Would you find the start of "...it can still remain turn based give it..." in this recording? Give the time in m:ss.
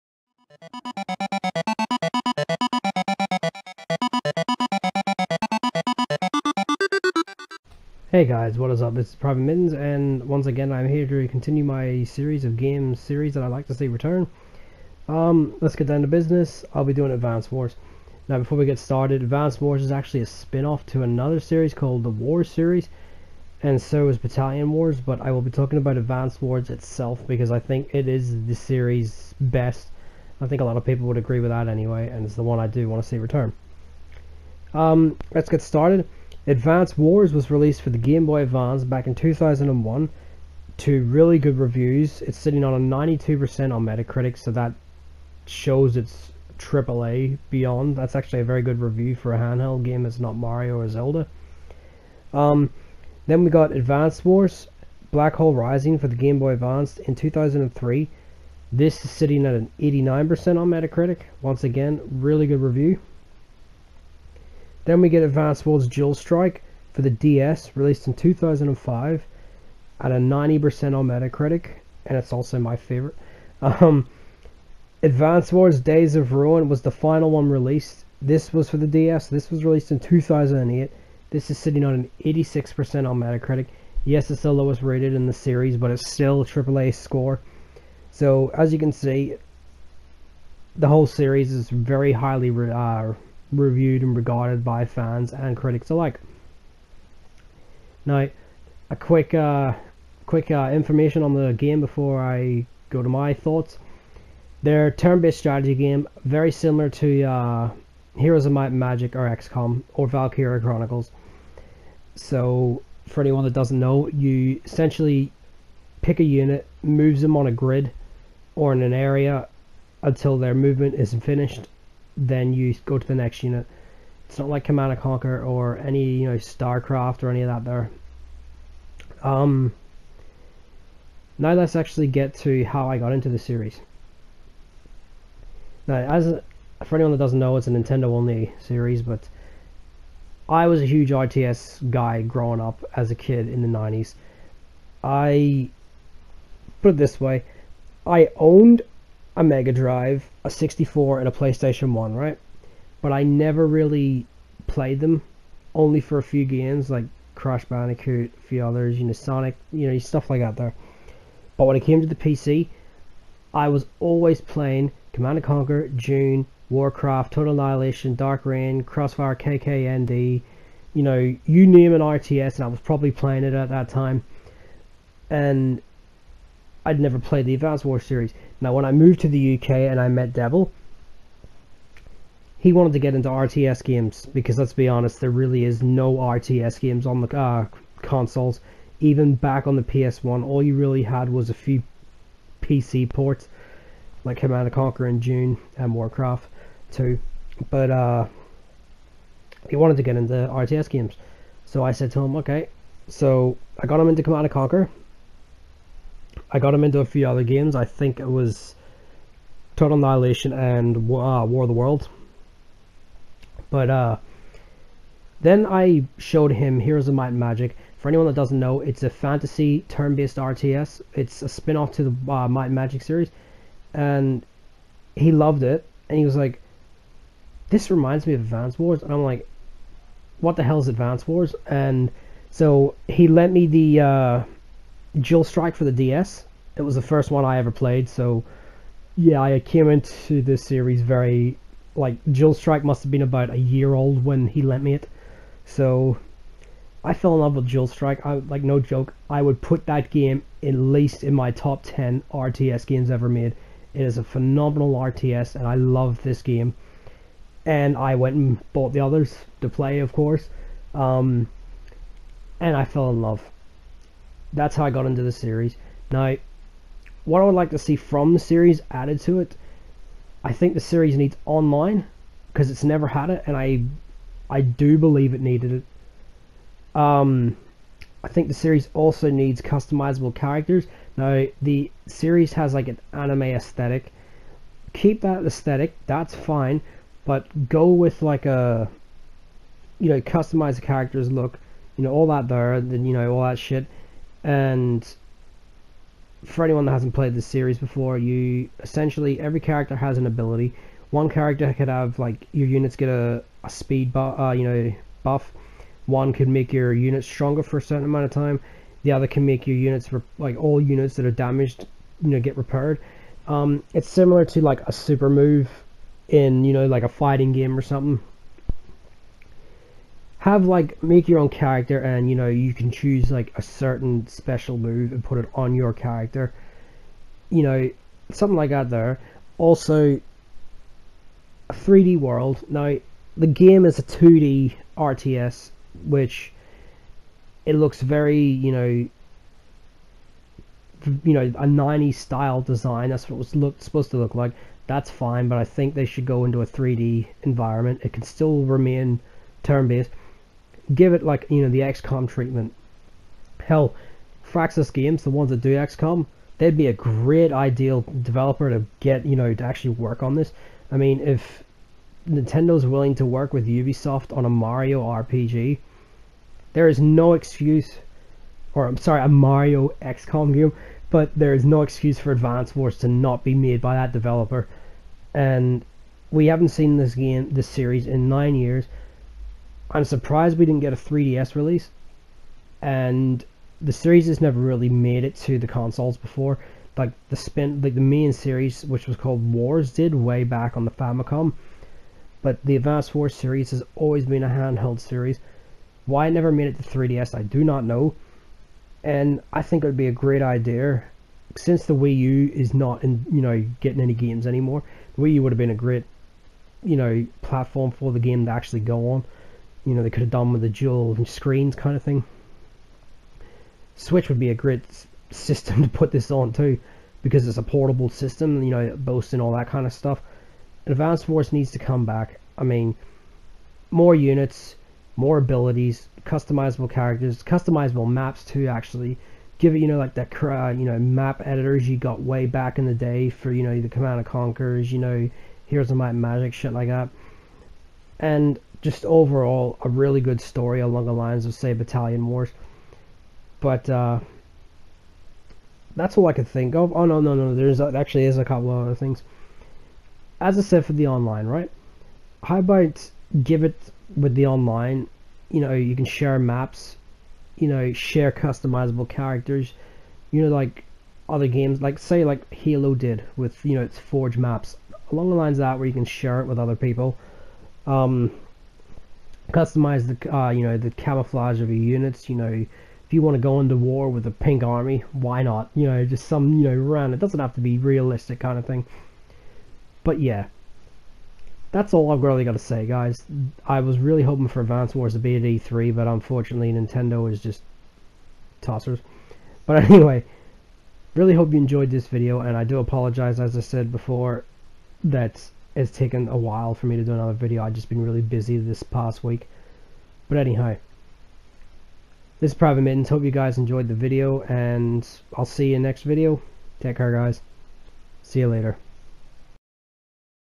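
5:48.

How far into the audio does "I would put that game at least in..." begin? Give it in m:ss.
4:09.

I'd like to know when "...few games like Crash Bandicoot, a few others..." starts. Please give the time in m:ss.
2:36.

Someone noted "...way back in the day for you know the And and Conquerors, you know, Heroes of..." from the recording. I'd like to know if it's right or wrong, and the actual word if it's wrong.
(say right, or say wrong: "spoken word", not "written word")
wrong: "Command", not "And".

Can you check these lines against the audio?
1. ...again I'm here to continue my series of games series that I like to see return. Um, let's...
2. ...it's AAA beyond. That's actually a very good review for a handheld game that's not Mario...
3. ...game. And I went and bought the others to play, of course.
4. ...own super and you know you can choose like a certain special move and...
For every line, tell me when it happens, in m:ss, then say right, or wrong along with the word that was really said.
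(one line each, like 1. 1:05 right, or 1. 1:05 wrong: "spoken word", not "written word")
1. 0:10 right
2. 0:45 right
3. 4:16 right
4. 5:21 wrong: "character", not "super".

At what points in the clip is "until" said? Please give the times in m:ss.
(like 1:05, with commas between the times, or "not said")
2:00.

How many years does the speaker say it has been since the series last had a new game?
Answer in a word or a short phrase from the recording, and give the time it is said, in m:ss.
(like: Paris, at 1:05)
9, at 6:18.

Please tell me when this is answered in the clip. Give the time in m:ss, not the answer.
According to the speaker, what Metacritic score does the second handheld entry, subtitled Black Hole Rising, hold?
0:59.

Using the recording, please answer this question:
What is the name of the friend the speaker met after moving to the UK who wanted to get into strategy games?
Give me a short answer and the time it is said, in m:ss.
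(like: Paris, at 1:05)
Devil, at 3:00.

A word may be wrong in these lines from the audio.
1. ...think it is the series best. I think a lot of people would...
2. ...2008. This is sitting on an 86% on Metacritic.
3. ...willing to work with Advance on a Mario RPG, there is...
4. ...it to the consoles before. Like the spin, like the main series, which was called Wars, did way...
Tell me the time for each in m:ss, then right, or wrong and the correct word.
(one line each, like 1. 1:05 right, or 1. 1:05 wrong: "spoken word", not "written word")
1. 0:27 right
2. 1:19 right
3. 6:02 wrong: "Ubisoft", not "Advance"
4. 6:25 right.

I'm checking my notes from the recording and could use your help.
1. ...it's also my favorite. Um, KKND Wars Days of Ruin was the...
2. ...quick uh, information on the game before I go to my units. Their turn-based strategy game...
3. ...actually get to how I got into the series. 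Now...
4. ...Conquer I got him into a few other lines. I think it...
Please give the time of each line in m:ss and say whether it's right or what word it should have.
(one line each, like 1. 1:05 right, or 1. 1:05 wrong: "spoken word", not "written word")
1. 1:12 wrong: "Advanced", not "KKND"
2. 1:40 wrong: "thoughts", not "units"
3. 2:11 right
4. 3:24 wrong: "games", not "lines".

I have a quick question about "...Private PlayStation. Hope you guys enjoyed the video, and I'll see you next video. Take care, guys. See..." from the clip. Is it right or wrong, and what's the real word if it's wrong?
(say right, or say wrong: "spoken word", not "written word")
wrong: "Mittens", not "PlayStation".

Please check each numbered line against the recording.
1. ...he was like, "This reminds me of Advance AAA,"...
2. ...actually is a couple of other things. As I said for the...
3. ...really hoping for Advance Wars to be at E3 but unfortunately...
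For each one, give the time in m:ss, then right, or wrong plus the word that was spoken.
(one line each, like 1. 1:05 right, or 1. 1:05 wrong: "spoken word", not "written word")
1. 3:46 wrong: "Wars", not "AAA"
2. 7:27 right
3. 8:03 right.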